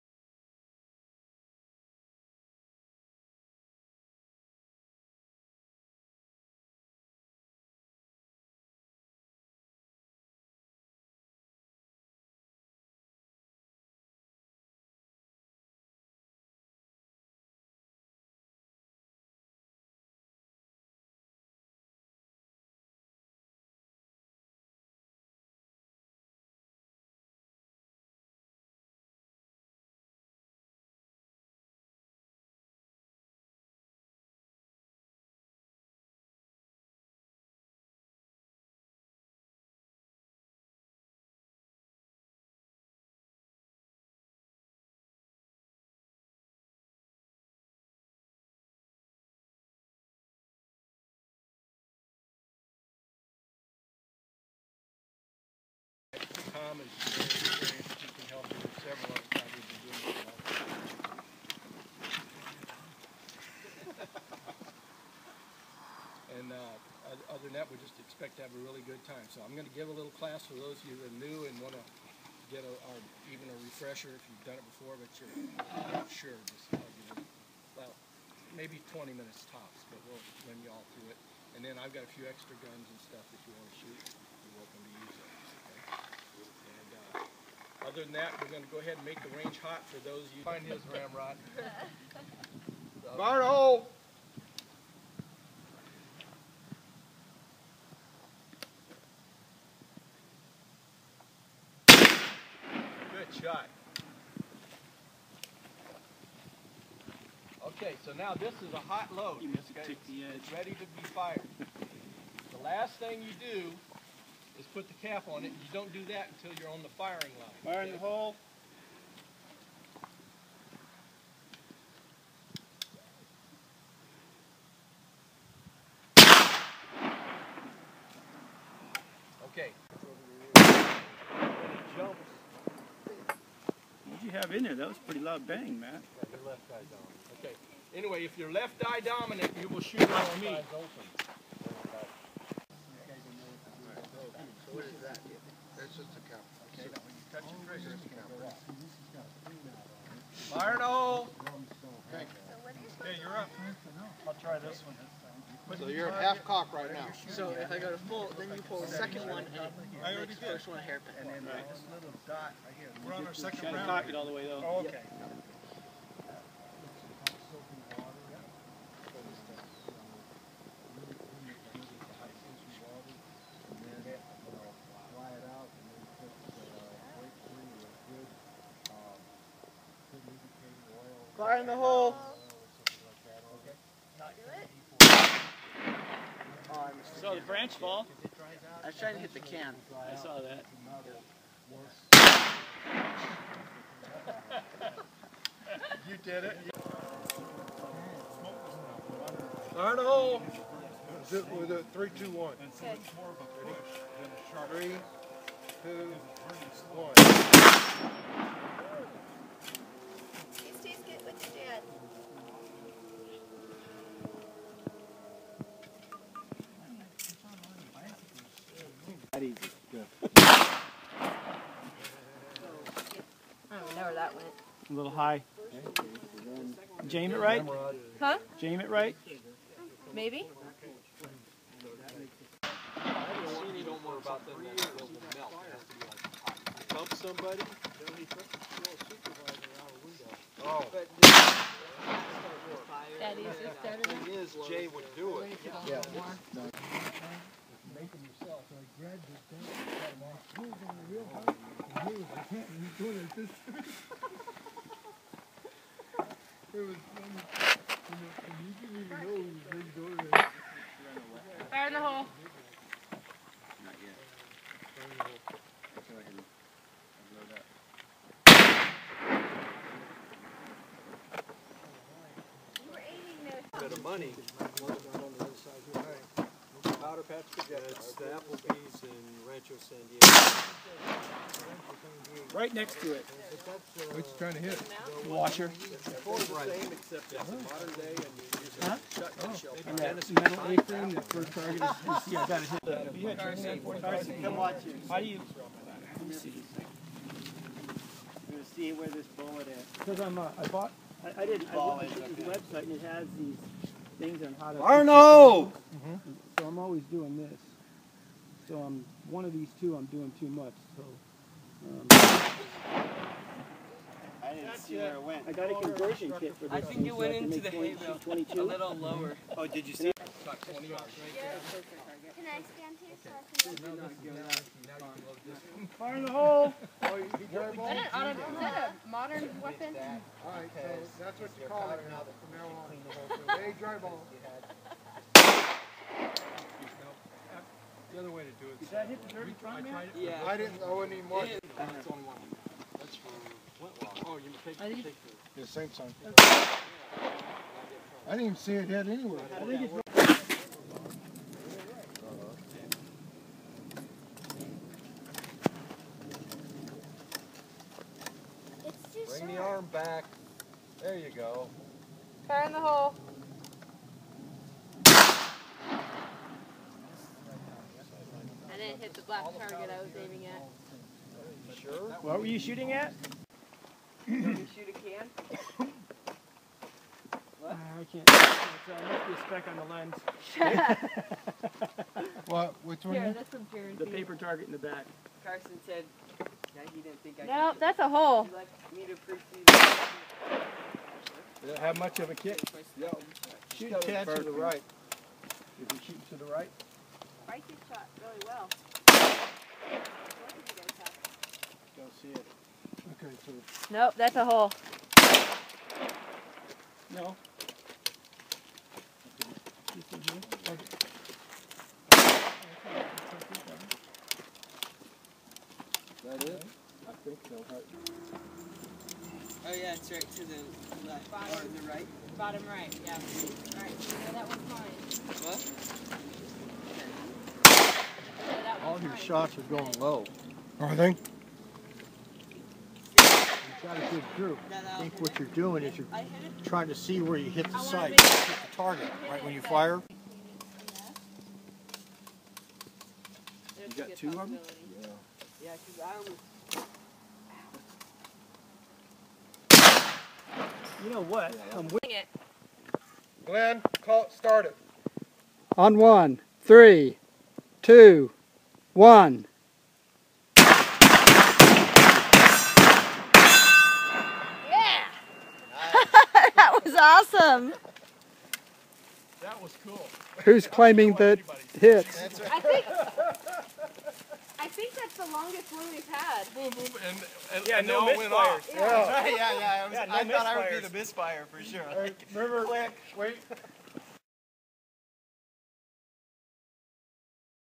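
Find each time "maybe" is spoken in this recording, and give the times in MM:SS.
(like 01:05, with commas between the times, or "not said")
01:18, 03:50.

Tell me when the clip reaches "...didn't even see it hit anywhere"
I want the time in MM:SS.
05:48.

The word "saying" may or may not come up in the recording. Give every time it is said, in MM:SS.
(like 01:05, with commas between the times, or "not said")
not said.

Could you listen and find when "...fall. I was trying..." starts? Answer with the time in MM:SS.
03:07.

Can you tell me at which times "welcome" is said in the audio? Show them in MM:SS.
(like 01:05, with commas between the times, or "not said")
01:24.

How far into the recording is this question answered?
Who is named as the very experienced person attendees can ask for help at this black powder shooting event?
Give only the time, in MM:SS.
00:56.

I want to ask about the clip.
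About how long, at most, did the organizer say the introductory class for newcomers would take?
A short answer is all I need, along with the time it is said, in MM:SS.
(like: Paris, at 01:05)
20 minutes, at 01:18.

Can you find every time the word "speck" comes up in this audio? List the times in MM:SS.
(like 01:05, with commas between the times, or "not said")
06:20.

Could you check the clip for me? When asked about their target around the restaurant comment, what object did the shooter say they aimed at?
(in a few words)
Washer.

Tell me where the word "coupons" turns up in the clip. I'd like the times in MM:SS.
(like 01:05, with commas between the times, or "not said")
not said.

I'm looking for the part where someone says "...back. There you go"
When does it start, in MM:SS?
05:59.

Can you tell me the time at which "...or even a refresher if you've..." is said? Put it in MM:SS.
01:12.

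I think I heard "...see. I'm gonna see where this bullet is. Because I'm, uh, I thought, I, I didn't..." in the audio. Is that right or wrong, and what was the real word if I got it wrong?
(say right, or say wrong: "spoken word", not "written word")
wrong: "bought", not "thought".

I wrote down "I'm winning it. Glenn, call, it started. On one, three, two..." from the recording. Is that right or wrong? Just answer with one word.
right.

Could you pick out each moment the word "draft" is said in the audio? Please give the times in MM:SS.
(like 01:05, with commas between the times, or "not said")
not said.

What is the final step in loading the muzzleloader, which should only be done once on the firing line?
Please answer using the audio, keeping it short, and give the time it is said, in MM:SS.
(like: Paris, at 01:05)
put the cap on, at 01:54.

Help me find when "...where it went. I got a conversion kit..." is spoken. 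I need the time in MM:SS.
05:14.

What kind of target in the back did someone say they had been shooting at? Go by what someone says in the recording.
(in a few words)
paper target.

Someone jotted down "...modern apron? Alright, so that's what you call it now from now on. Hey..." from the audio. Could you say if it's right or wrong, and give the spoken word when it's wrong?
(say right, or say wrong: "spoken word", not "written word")
wrong: "weapon", not "apron".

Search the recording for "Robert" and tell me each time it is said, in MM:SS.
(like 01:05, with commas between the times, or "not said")
not said.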